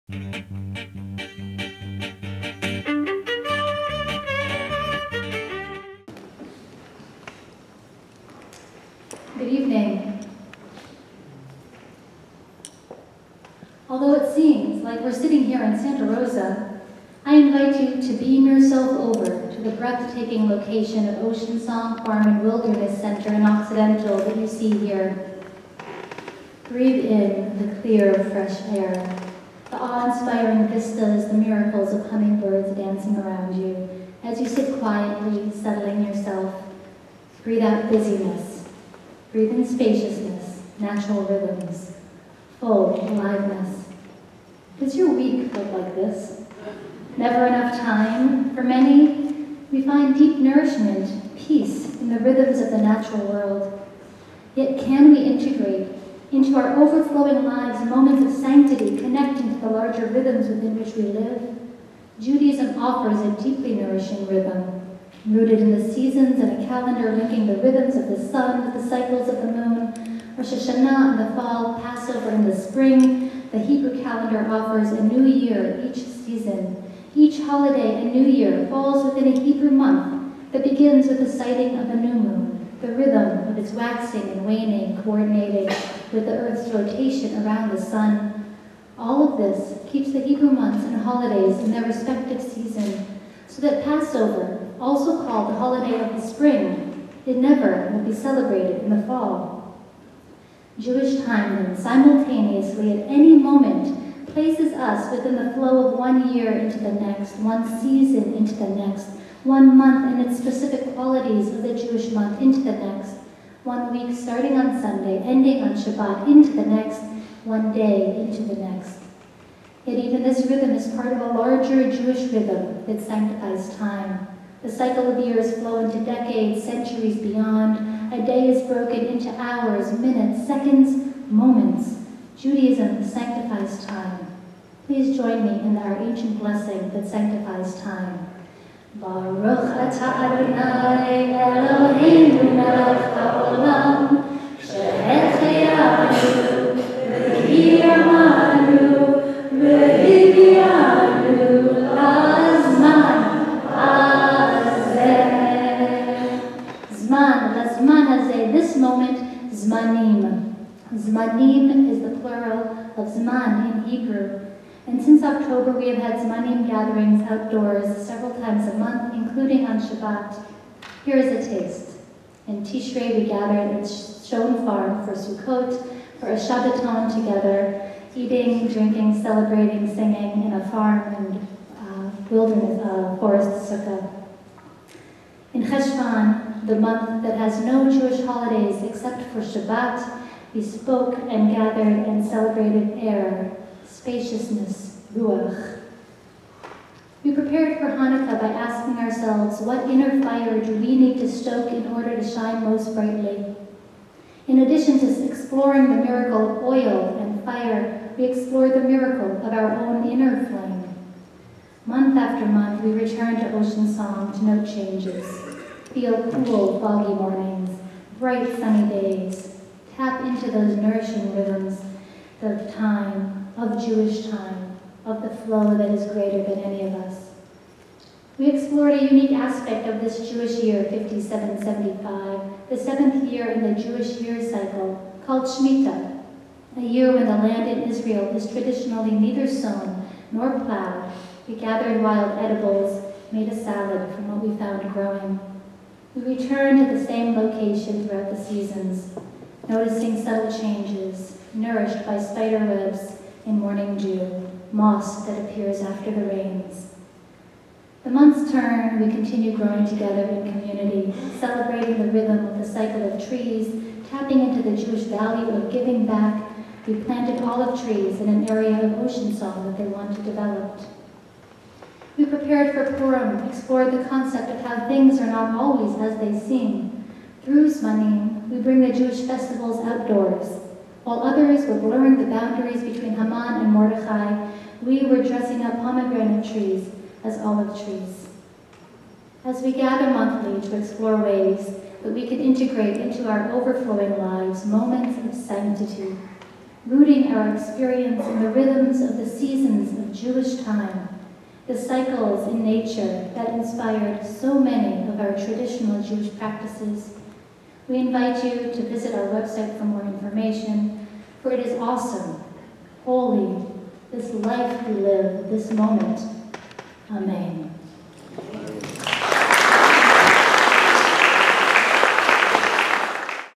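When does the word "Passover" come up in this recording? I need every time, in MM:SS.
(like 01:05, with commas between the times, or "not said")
01:11, 01:33.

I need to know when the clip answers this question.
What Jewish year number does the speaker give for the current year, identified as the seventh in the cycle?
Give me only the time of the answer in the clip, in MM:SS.
03:50.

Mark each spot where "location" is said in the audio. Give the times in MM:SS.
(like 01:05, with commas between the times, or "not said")
00:20, 04:07.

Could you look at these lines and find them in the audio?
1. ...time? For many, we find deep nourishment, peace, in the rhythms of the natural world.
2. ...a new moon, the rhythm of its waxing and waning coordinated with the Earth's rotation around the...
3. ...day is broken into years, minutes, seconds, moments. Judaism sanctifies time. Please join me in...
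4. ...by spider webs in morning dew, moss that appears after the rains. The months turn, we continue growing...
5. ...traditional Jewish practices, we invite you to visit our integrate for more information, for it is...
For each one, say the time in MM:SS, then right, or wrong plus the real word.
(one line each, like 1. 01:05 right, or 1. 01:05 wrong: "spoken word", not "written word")
1. 00:47 right
2. 01:21 right
3. 02:08 wrong: "hours", not "years"
4. 04:12 right
5. 05:05 wrong: "website", not "integrate".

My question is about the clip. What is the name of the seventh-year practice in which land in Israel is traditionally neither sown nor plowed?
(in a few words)
Shemitah.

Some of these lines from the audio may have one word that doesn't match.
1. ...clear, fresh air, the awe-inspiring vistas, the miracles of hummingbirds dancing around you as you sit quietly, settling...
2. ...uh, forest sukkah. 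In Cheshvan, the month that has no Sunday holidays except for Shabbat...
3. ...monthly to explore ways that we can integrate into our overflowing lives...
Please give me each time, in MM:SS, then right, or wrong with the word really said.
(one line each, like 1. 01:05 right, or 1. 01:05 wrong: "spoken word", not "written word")
1. 00:27 right
2. 03:02 wrong: "Jewish", not "Sunday"
3. 04:50 right.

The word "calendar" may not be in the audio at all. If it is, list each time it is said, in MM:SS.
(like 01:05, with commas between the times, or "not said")
01:06, 01:14.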